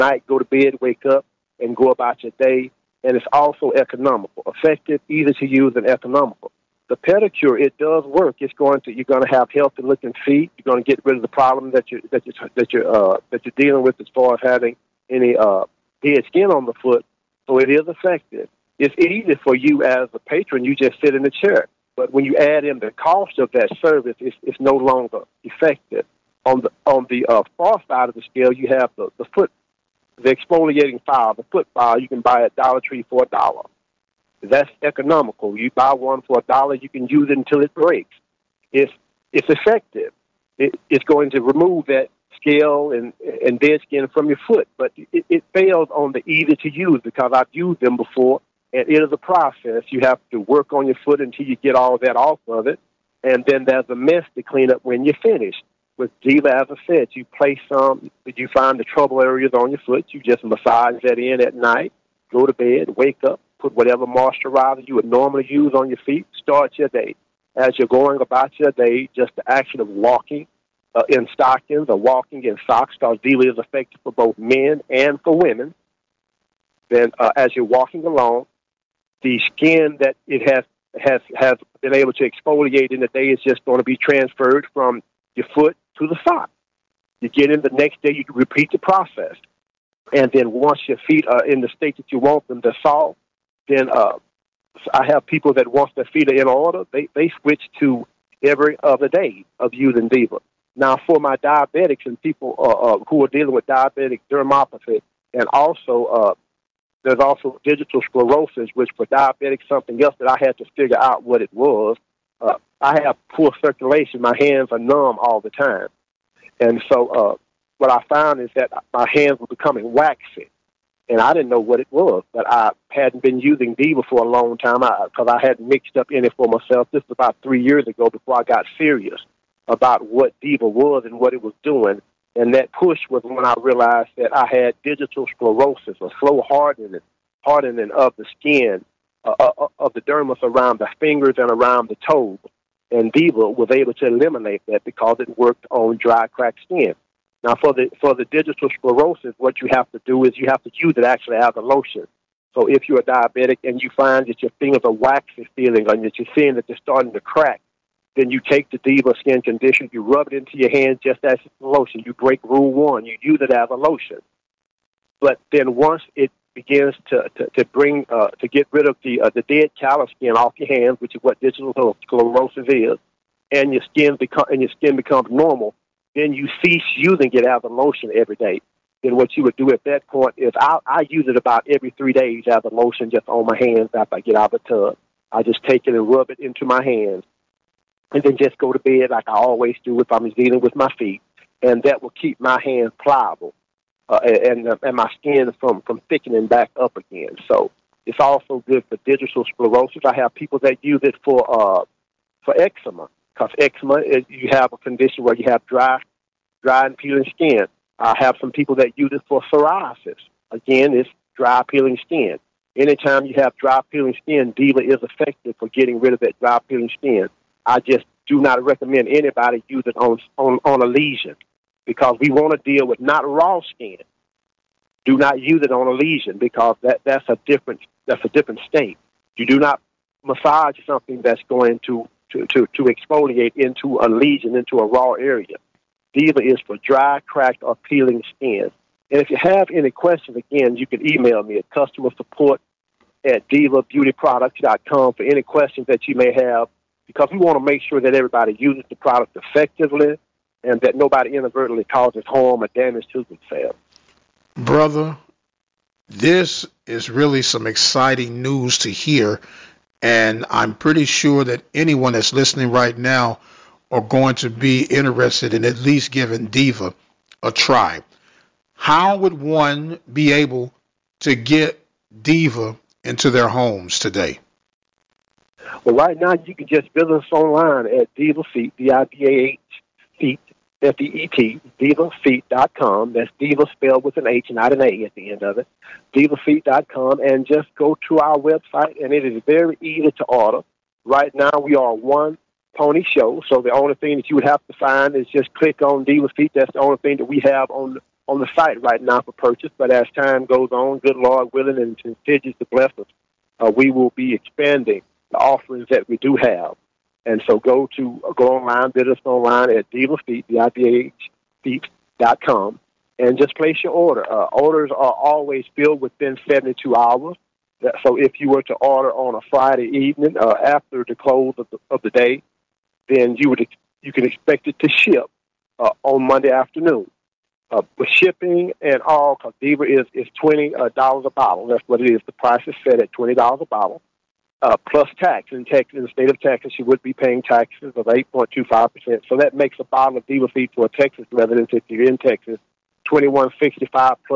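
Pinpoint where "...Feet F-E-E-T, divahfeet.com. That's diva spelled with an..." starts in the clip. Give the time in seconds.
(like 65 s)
280 s.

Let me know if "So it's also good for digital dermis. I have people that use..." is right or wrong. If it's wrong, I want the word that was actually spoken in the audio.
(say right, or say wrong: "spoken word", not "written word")
wrong: "sclerosis", not "dermis".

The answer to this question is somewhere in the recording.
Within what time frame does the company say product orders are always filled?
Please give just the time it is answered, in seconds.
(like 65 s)
316 s.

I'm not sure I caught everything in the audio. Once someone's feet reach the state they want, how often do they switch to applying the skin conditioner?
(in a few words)
every other day.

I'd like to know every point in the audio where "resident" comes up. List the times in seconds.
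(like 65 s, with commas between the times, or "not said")
341 s.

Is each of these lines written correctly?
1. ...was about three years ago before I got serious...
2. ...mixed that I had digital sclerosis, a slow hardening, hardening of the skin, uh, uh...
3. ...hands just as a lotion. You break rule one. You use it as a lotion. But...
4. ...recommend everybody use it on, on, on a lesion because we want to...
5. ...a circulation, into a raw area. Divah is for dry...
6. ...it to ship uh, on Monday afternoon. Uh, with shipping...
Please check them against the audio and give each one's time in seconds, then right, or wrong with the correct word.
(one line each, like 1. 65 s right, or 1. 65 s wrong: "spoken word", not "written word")
1. 127 s right
2. 133 s wrong: "realized", not "mixed"
3. 160 s right
4. 218 s wrong: "anybody", not "everybody"
5. 233 s wrong: "lesion", not "circulation"
6. 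324 s right.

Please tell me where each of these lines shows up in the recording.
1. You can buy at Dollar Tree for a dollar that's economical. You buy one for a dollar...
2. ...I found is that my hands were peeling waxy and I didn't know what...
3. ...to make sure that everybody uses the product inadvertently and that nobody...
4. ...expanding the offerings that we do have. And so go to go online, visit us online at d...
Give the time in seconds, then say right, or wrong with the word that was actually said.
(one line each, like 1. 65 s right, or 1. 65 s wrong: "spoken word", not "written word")
1. 31 s right
2. 117 s wrong: "becoming", not "peeling"
3. 247 s wrong: "effectively", not "inadvertently"
4. 304 s right.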